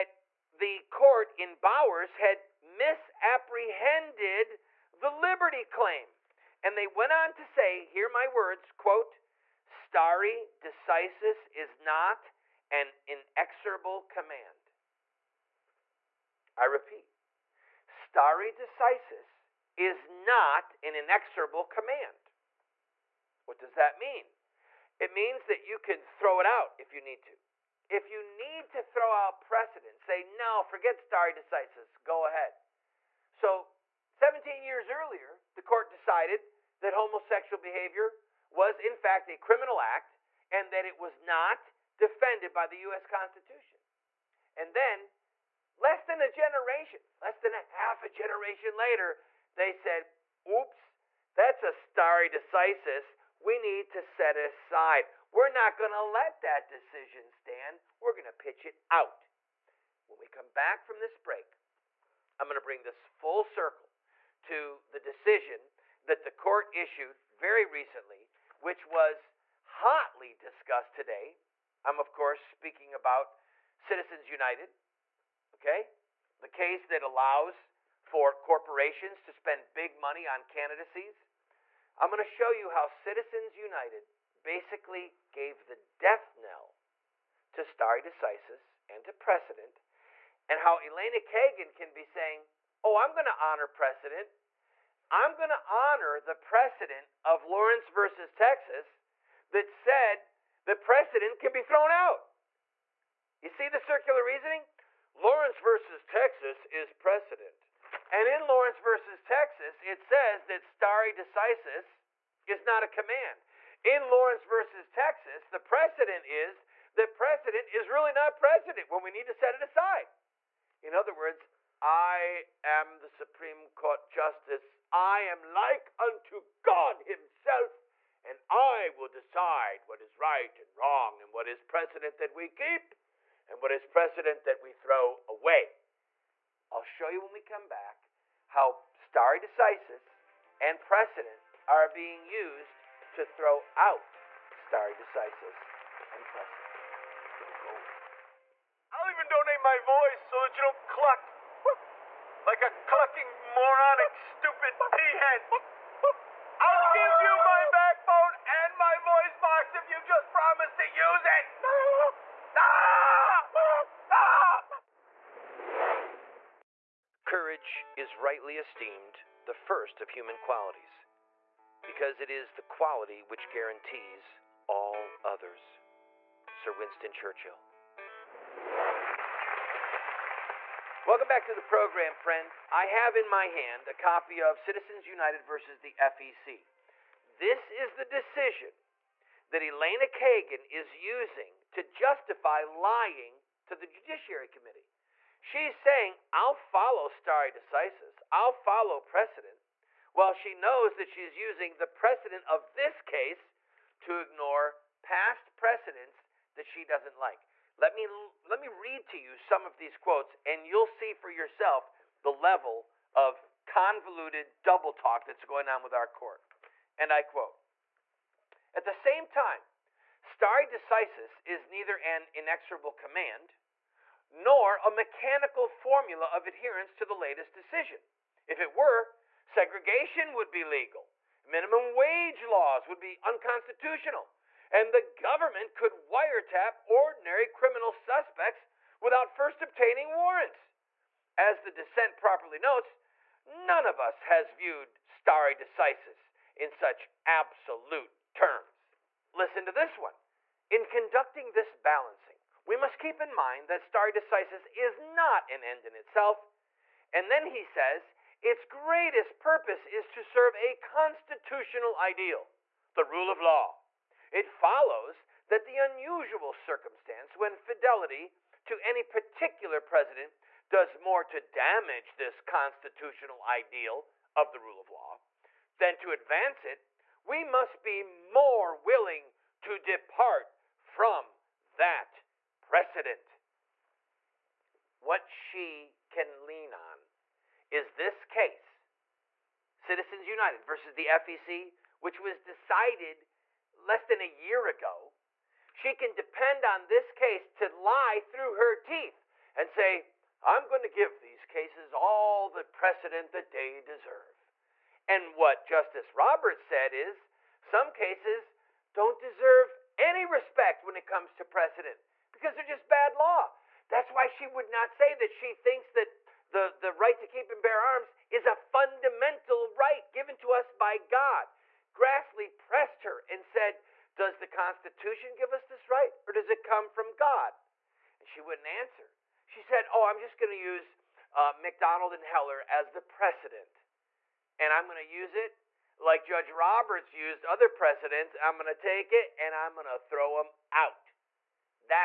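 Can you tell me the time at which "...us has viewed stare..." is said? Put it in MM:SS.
04:03.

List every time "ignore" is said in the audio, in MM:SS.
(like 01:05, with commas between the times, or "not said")
03:24.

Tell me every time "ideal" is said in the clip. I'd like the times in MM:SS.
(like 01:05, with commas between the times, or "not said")
04:21, 04:33.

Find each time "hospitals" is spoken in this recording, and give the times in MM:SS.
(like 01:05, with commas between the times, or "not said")
not said.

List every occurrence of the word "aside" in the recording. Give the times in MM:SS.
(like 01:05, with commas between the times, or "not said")
00:54, 01:59.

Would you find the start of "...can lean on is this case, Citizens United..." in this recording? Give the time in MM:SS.
04:46.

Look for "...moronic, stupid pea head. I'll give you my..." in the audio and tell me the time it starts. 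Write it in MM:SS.
02:33.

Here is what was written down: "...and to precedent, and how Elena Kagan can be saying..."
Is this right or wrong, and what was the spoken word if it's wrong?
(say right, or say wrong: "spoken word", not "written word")
right.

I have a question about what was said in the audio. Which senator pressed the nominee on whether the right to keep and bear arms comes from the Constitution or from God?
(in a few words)
Grassley.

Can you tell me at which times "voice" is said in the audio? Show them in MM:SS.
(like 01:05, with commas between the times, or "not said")
02:29, 02:38.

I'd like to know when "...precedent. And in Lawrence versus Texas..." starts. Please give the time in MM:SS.
01:46.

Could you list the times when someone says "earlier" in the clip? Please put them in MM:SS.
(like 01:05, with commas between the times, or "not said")
00:34.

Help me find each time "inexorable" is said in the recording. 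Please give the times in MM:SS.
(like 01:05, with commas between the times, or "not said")
00:13, 00:20, 03:42.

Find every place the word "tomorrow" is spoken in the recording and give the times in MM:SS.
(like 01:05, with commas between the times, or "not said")
not said.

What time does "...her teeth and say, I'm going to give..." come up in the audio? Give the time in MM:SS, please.
04:58.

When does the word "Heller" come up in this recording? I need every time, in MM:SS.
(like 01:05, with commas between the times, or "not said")
05:32.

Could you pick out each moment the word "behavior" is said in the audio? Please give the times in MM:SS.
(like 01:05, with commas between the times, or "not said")
00:37.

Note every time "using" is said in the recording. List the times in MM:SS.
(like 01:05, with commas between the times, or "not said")
03:10, 03:21.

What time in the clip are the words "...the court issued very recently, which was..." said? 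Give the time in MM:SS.
01:06.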